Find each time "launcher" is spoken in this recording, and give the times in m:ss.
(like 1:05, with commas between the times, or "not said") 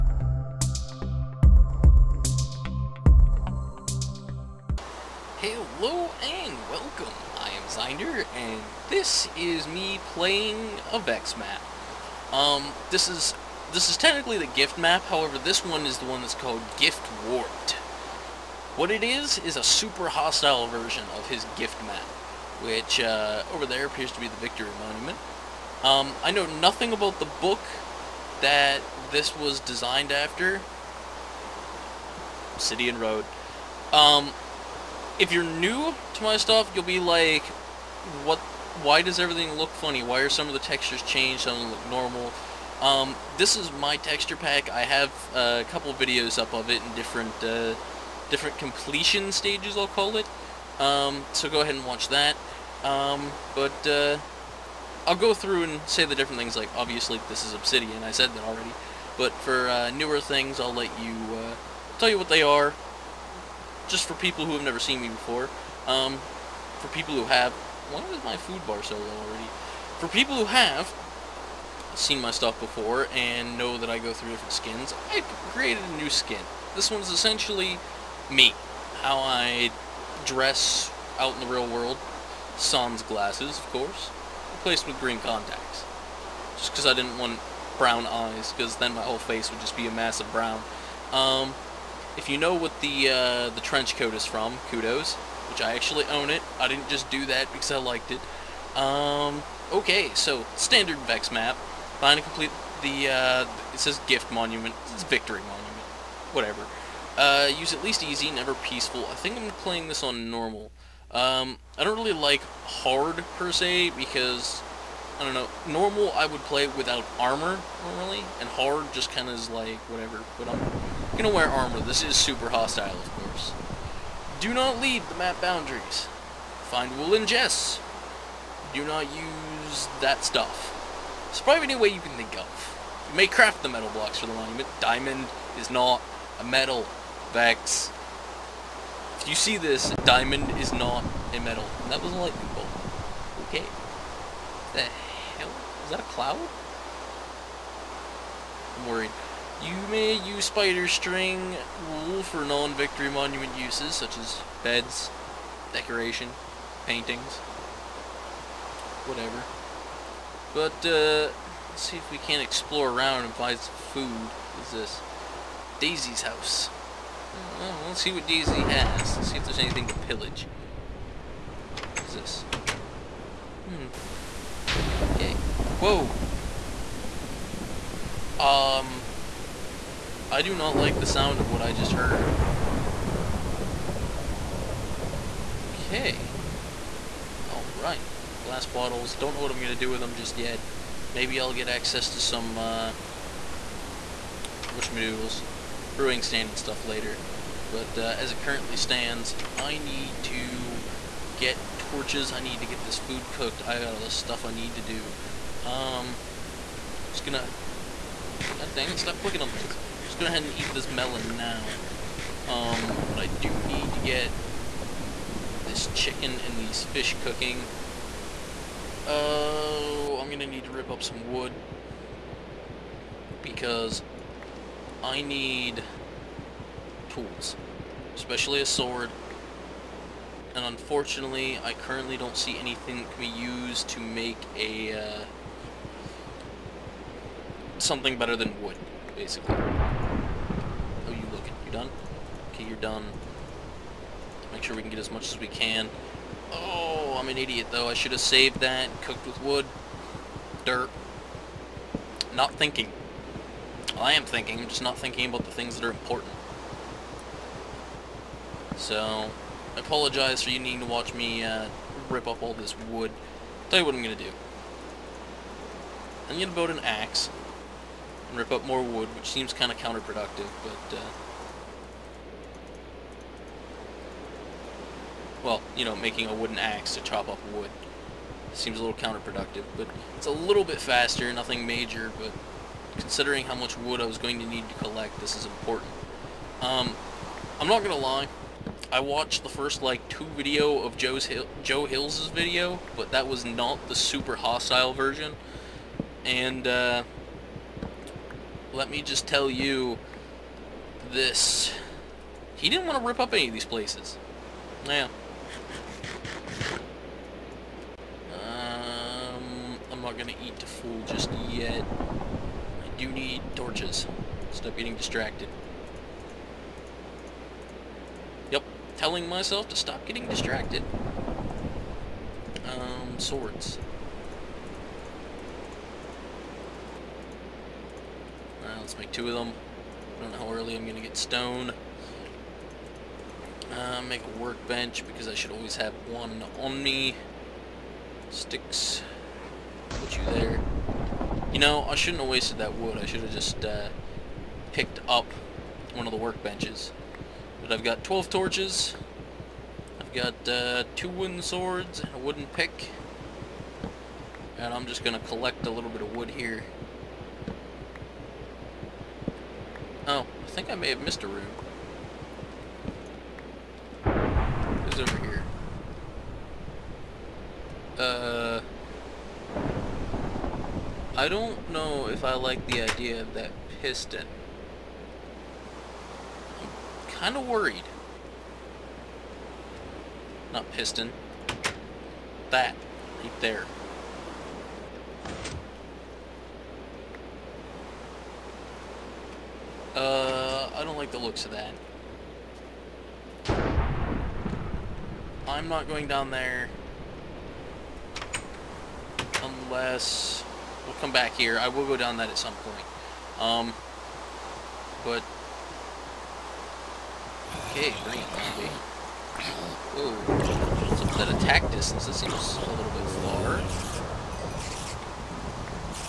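not said.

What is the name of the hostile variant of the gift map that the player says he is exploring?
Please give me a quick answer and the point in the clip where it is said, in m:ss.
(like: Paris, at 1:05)
Gift Warped, at 0:16.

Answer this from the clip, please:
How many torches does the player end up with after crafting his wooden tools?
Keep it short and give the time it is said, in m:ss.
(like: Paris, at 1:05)
12, at 5:48.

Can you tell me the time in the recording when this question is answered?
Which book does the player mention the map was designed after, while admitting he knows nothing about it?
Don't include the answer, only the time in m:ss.
0:32.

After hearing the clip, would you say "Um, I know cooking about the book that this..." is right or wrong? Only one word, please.
wrong.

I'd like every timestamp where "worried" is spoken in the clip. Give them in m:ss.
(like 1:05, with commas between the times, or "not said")
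2:28, 6:17.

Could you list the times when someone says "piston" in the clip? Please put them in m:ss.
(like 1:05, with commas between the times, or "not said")
6:13, 6:20.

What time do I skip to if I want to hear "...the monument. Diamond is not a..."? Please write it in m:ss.
2:14.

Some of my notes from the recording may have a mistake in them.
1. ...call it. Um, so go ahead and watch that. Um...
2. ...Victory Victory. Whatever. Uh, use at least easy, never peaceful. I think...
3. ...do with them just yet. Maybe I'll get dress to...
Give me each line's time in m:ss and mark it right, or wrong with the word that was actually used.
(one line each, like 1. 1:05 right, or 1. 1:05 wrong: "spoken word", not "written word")
1. 0:49 right
2. 1:45 wrong: "Monument", not "Victory"
3. 3:09 wrong: "access", not "dress".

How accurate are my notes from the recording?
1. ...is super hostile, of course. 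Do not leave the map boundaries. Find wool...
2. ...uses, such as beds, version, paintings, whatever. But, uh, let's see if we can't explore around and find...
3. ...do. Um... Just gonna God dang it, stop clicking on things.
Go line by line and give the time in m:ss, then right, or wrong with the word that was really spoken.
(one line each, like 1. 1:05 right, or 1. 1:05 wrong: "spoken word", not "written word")
1. 2:02 right
2. 2:33 wrong: "decoration", not "version"
3. 3:24 right.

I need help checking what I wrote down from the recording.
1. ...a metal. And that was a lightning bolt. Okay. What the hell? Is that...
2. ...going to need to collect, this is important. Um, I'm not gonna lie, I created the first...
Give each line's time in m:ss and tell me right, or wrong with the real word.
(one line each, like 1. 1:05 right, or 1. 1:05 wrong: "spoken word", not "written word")
1. 2:21 right
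2. 4:44 wrong: "watched", not "created".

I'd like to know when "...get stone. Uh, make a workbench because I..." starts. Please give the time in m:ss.
5:31.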